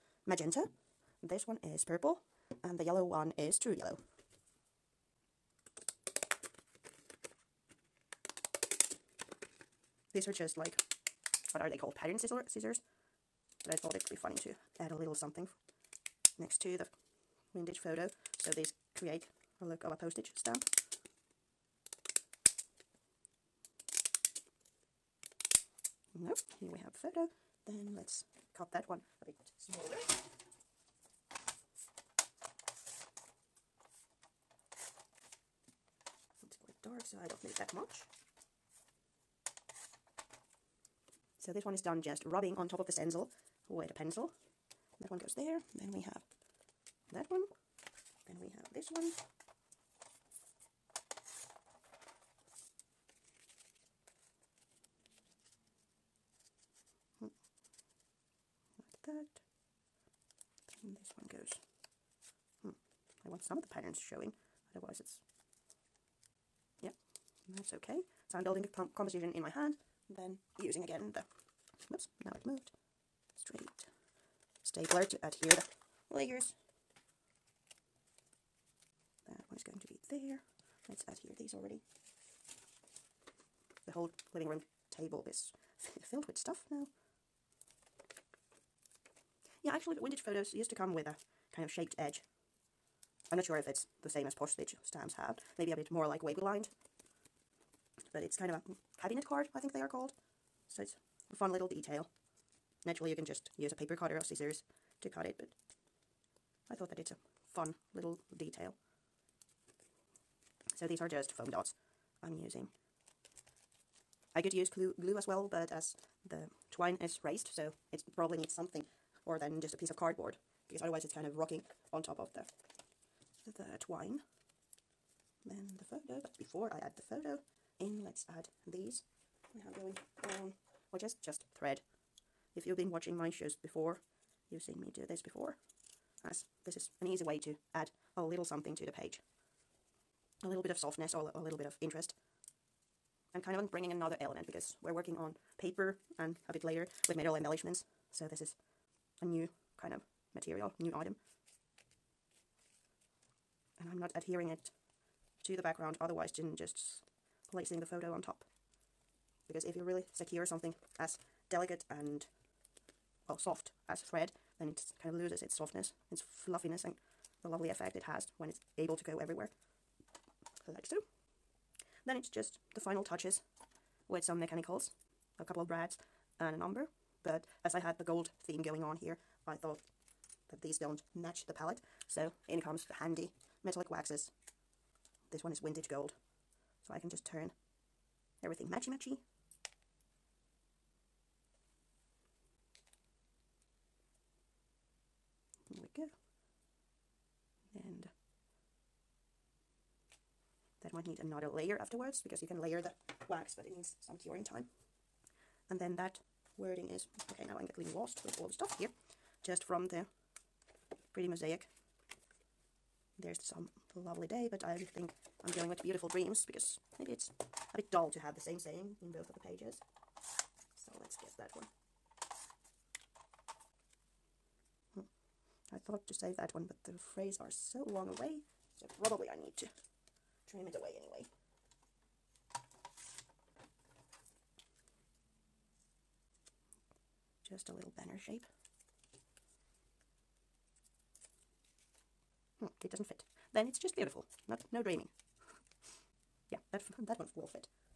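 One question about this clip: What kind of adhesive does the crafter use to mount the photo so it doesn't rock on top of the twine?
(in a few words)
Foam dots.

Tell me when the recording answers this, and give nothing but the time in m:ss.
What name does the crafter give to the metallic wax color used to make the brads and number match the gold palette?
3:05.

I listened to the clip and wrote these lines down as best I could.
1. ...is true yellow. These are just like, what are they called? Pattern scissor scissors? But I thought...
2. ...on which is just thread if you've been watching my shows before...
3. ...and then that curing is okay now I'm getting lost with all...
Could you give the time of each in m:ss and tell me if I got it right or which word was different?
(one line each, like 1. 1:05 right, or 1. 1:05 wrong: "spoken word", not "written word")
1. 0:03 right
2. 2:10 right
3. 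3:25 wrong: "wording", not "curing".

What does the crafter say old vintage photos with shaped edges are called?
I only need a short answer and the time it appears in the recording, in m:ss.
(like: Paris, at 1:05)
Cabinet card, at 1:39.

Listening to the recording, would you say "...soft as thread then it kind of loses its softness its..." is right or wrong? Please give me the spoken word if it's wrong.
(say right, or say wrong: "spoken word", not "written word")
right.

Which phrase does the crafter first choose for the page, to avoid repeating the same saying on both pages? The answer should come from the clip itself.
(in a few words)
Beautiful dreams.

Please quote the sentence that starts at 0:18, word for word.
So these create a look of a postage stamp.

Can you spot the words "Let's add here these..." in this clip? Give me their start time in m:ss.
1:20.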